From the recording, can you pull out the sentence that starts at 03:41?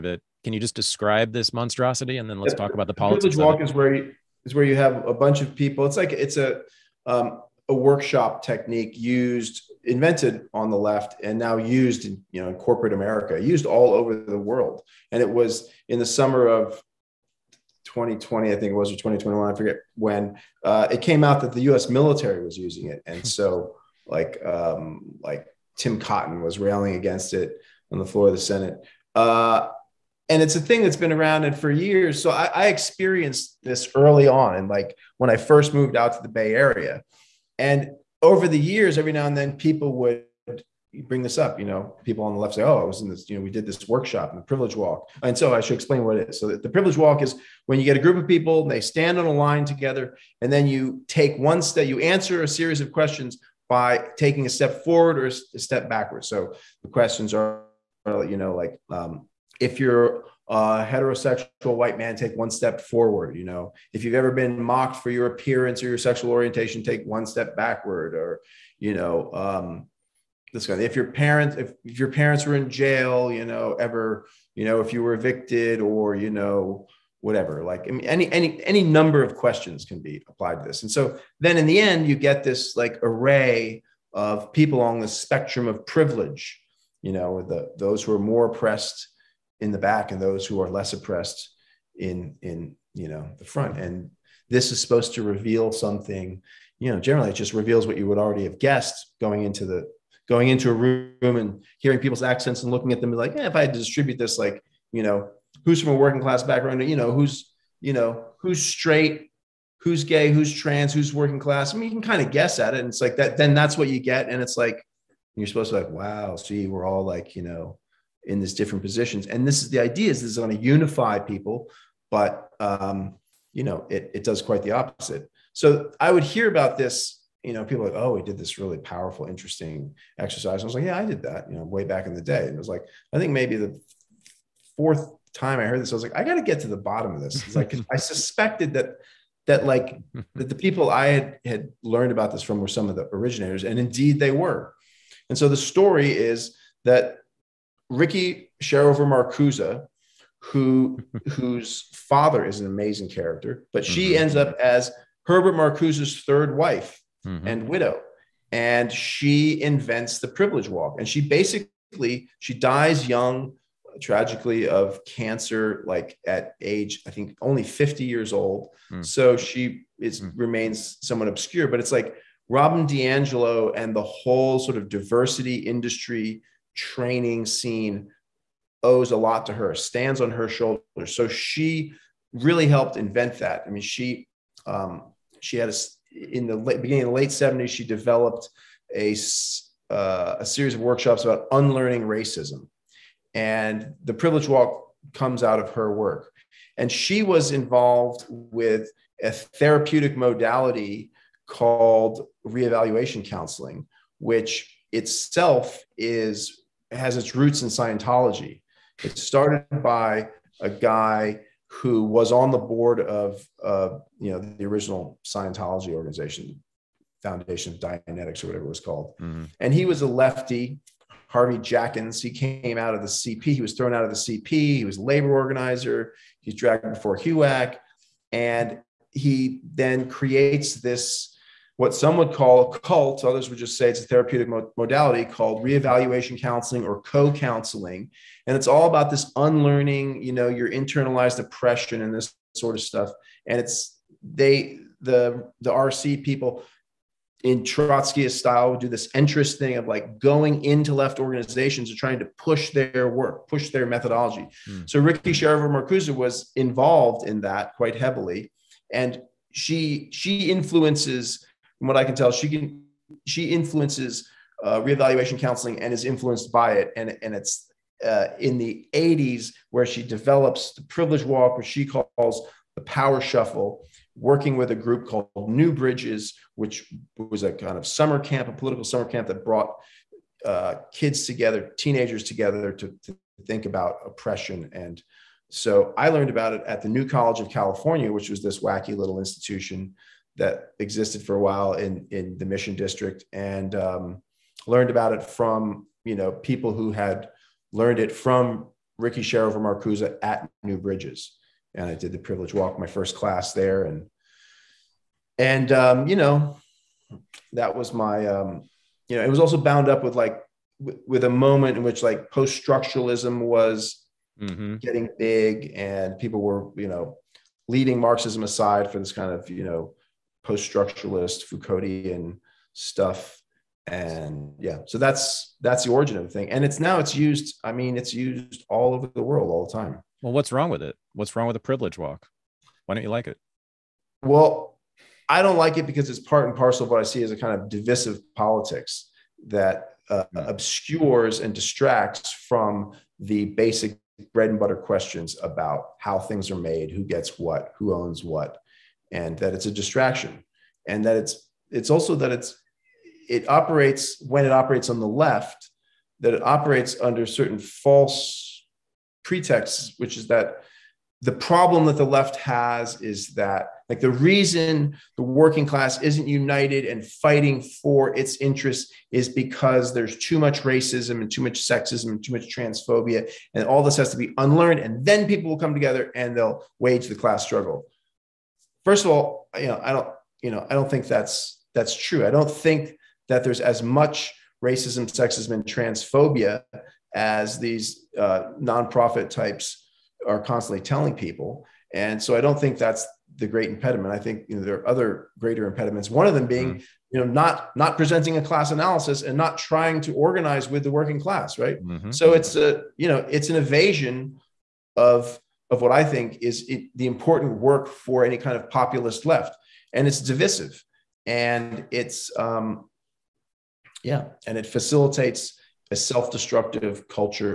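Harvey Jackins, he came out of the CP.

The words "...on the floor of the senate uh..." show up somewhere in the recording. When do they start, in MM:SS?
00:27.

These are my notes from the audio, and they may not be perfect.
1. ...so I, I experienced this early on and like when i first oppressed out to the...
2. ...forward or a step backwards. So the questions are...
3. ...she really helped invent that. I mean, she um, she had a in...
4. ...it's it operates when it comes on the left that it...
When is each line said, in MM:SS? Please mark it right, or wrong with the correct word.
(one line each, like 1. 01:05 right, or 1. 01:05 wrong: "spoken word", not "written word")
1. 00:32 wrong: "moved", not "oppressed"
2. 00:54 right
3. 03:01 right
4. 05:52 wrong: "operates", not "comes".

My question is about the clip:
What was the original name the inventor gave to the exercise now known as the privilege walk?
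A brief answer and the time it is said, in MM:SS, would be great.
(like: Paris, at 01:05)
The power shuffle, at 04:32.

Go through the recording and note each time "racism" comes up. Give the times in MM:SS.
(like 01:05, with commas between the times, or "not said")
03:12, 06:10, 06:24.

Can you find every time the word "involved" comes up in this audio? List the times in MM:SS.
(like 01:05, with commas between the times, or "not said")
03:17, 04:16.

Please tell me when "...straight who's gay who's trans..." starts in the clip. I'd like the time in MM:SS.
01:48.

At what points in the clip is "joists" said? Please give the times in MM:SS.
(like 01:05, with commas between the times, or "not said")
not said.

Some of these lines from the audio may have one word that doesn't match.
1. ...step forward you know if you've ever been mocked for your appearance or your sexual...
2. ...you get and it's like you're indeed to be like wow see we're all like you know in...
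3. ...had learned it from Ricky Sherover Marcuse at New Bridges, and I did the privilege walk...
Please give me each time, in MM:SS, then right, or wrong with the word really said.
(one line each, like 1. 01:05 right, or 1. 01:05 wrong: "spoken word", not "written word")
1. 01:02 right
2. 01:53 wrong: "supposed", not "indeed"
3. 04:56 right.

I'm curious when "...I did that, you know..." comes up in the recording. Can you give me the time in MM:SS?
02:10.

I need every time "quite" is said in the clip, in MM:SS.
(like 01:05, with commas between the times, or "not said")
02:04, 04:17.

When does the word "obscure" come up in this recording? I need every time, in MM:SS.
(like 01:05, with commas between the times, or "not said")
02:51, 05:40.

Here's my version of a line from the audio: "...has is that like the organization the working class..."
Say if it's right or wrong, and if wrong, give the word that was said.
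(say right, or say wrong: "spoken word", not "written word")
wrong: "reason", not "organization".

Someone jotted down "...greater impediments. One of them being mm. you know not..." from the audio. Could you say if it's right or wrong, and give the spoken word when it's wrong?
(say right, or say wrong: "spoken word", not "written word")
right.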